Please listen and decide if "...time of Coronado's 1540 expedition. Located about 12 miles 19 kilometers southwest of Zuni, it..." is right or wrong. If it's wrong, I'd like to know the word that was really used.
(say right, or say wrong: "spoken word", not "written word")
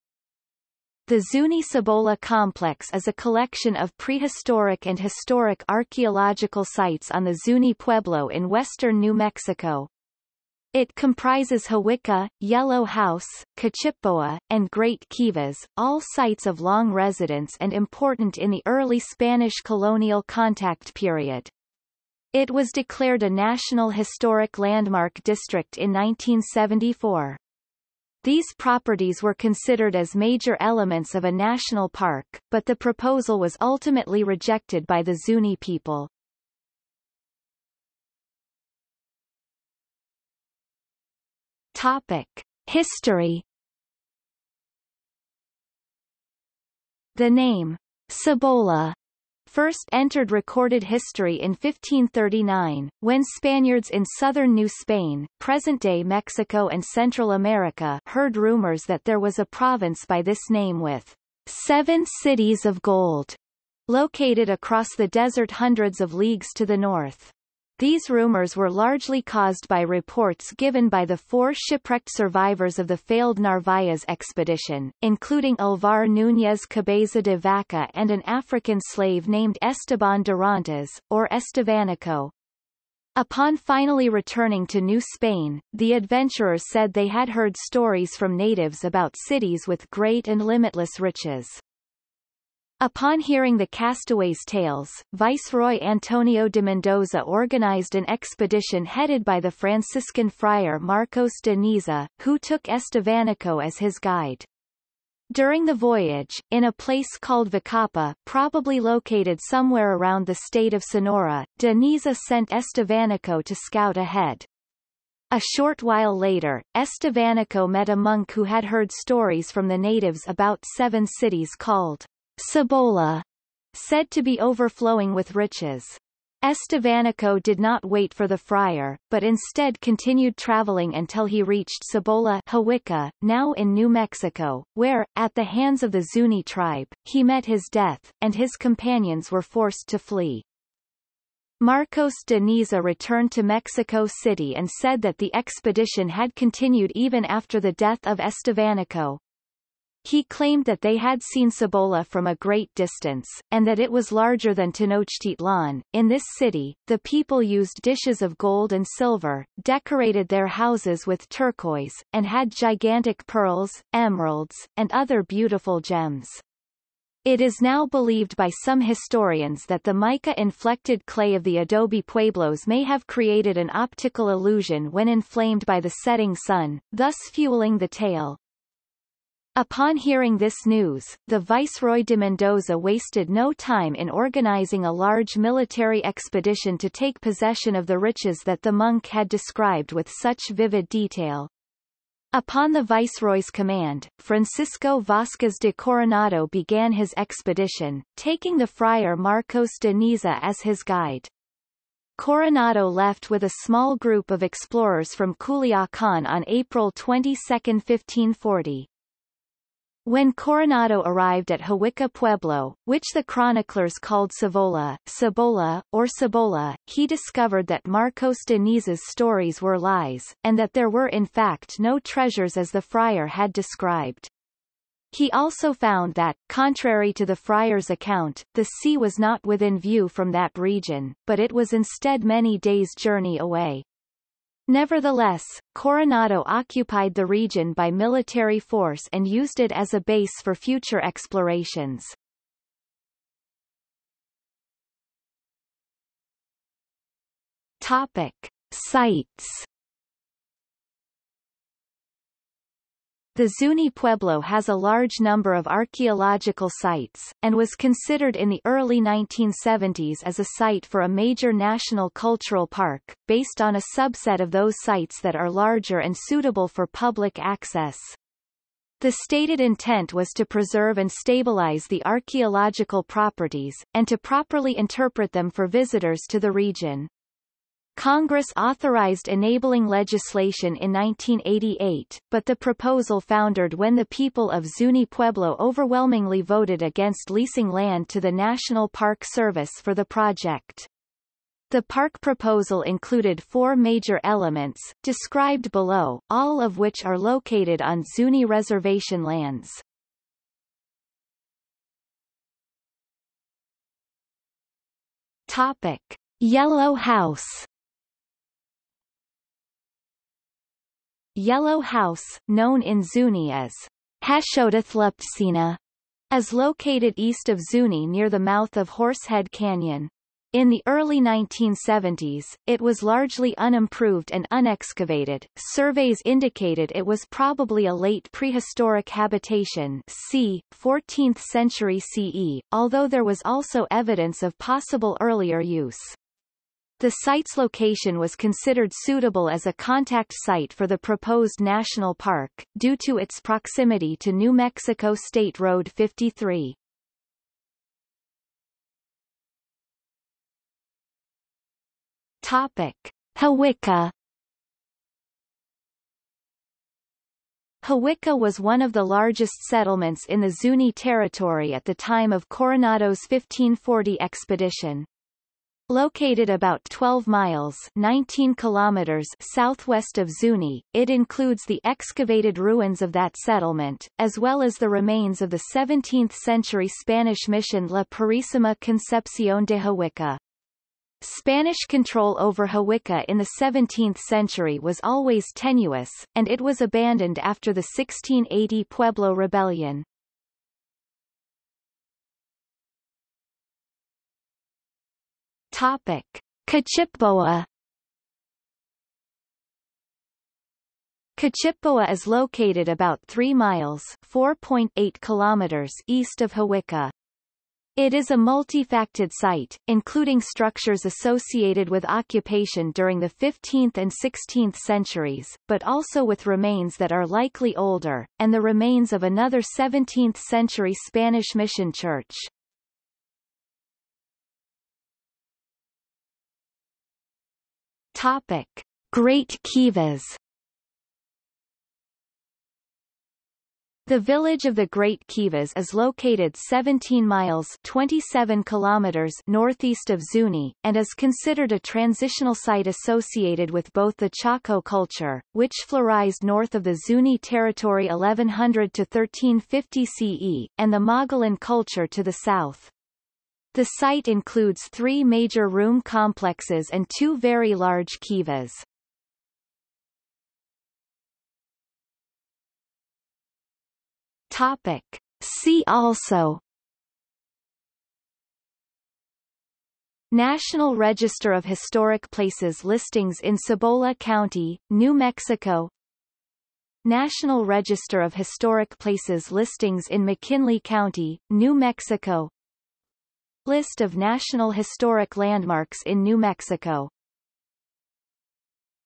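right.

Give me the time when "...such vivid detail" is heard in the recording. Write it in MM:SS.
03:10.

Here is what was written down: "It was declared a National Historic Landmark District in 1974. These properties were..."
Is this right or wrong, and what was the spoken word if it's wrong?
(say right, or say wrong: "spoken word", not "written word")
right.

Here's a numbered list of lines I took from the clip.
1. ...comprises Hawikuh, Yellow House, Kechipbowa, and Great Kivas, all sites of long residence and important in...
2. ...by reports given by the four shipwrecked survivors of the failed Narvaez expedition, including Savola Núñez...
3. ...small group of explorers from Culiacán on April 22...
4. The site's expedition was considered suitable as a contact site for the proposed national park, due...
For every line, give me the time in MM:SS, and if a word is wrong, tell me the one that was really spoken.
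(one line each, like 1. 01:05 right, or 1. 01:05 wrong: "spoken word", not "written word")
1. 00:10 right
2. 01:09 wrong: "Alvar", not "Savola"
3. 03:23 right
4. 05:37 wrong: "location", not "expedition".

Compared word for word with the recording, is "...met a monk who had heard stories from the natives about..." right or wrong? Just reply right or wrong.
right.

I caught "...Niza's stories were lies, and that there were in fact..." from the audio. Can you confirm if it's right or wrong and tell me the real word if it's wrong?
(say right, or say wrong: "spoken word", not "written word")
right.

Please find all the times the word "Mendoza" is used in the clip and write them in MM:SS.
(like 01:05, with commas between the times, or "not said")
01:36, 03:02.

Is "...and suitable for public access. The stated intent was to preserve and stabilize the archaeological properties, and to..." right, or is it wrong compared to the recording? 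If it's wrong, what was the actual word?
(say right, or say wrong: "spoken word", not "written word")
right.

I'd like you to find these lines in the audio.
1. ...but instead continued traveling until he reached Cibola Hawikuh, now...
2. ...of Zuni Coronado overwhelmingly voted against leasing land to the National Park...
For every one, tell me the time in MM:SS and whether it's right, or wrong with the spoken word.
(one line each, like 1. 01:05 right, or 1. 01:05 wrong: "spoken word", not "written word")
1. 02:09 right
2. 04:44 wrong: "Pueblo", not "Coronado".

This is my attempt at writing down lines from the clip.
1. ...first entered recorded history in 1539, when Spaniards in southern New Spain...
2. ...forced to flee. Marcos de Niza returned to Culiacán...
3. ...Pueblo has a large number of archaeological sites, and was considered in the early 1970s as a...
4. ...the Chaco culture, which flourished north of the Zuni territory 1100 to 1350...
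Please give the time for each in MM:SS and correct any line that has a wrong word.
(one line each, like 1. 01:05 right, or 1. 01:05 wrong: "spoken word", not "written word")
1. 00:49 right
2. 02:19 wrong: "Mexico", not "Culiacán"
3. 04:13 right
4. 07:24 right.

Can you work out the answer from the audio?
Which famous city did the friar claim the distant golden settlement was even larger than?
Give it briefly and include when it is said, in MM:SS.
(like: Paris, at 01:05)
Tenochtitlan, at 02:34.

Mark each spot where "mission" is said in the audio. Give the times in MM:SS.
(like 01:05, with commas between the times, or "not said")
06:17, 07:01.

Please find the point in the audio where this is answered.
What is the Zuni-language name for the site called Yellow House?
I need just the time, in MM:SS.
05:14.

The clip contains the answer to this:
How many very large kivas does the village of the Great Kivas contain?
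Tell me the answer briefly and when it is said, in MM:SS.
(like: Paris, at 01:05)
2, at 07:37.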